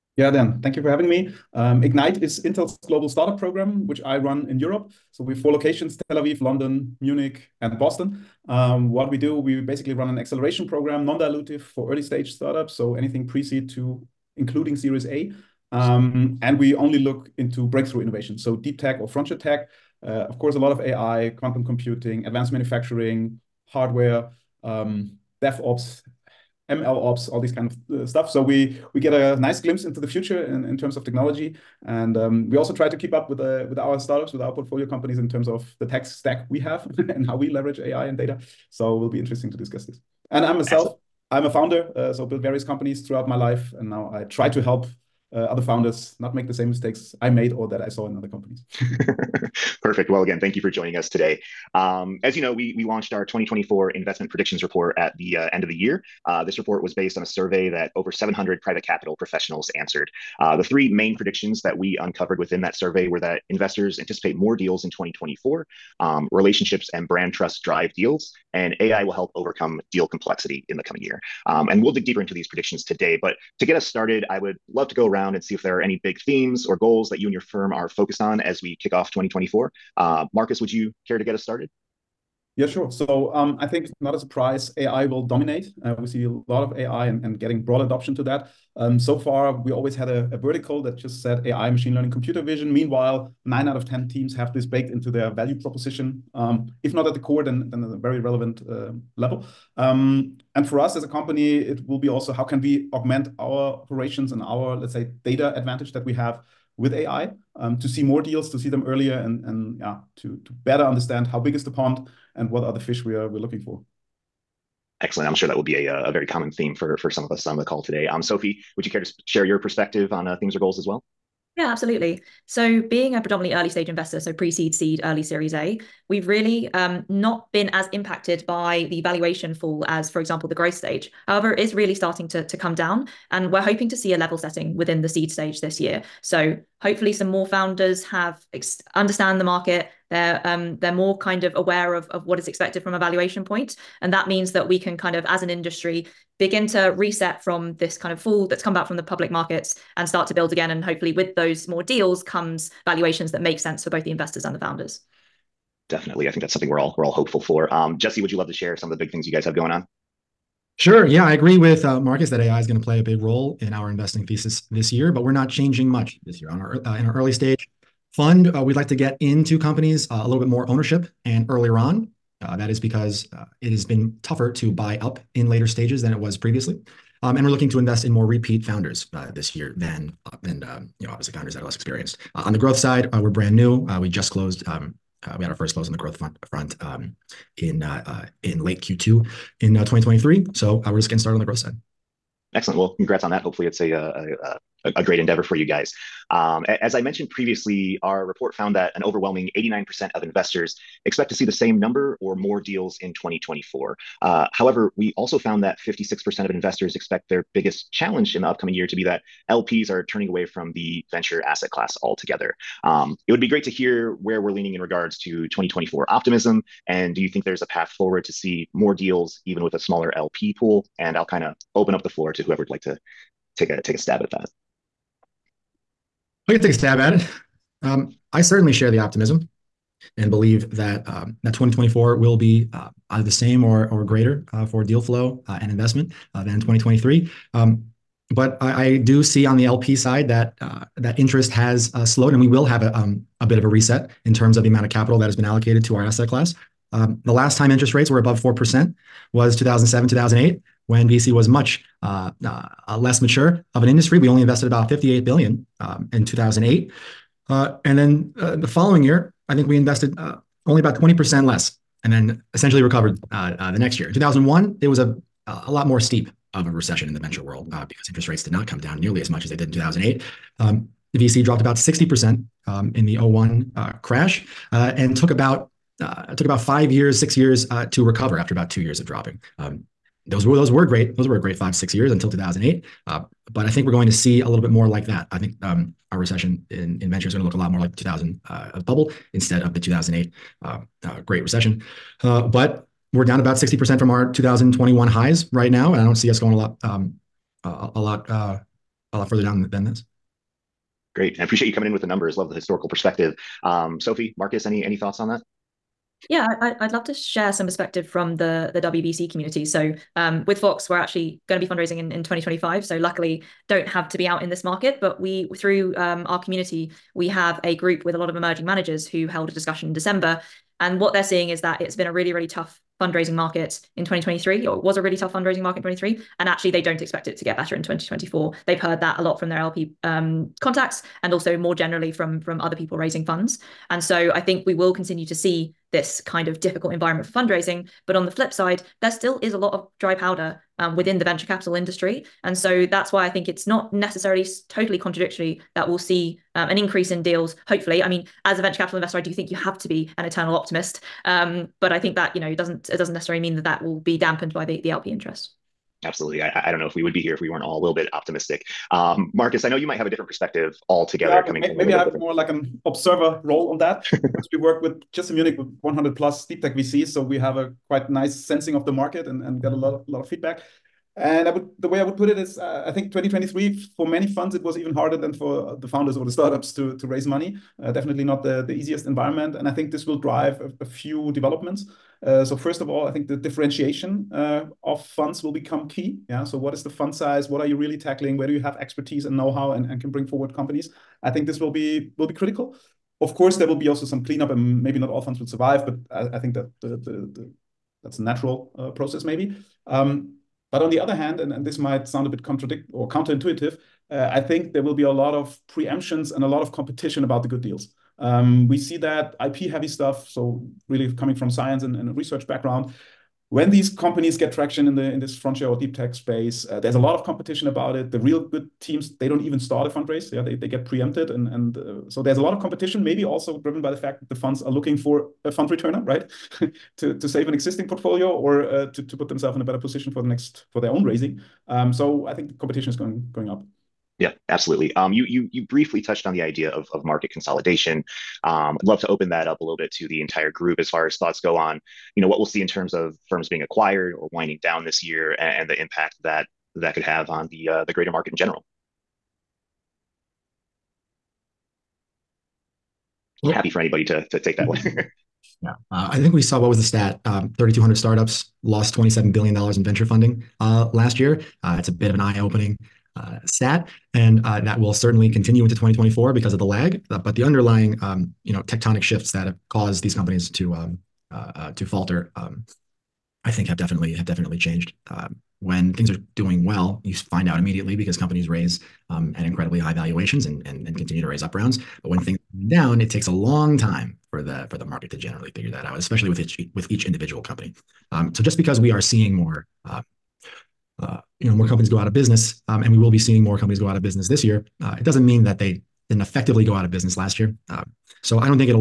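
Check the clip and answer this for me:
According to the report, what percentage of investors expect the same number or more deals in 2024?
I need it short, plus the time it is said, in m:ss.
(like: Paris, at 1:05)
89%, at 3:19.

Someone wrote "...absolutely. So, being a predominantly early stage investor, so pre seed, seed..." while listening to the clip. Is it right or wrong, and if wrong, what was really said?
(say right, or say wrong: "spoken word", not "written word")
right.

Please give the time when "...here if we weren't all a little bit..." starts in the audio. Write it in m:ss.
5:57.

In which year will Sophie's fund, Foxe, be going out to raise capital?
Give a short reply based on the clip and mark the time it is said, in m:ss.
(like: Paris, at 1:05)
2025, at 5:12.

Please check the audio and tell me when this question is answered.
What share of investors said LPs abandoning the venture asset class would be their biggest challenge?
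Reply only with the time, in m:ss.
3:25.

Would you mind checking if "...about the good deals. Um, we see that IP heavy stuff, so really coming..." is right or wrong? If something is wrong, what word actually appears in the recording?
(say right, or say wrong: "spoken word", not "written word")
right.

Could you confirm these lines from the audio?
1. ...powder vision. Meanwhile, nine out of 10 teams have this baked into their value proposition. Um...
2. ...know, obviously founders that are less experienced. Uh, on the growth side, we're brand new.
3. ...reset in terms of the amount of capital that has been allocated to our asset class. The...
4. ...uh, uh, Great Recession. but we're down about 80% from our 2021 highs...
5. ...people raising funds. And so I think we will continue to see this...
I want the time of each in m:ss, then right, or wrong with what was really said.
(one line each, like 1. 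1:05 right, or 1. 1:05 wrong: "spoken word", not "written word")
1. 1:32 wrong: "computer", not "powder"
2. 3:01 right
3. 4:03 right
4. 4:50 wrong: "60", not "80"
5. 5:32 right.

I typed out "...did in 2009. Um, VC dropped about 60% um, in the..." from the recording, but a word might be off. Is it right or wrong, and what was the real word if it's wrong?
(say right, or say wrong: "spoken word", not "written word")
wrong: "2008", not "2009".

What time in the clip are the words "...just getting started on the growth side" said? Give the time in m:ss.
3:10.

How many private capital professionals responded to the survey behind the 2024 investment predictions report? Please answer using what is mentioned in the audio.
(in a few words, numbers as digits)
over 700.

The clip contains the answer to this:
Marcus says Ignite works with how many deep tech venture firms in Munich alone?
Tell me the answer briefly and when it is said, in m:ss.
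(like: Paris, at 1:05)
100 plus, at 6:05.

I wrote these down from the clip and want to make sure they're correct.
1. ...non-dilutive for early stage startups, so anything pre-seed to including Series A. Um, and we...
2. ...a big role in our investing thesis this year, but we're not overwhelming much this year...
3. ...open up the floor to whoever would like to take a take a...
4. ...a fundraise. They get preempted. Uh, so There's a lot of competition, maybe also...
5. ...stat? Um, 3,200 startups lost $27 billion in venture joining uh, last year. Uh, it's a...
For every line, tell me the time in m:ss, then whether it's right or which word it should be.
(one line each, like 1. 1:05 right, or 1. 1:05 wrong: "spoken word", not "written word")
1. 0:11 right
2. 2:42 wrong: "changing", not "overwhelming"
3. 3:41 right
4. 6:59 right
5. 7:36 wrong: "funding", not "joining".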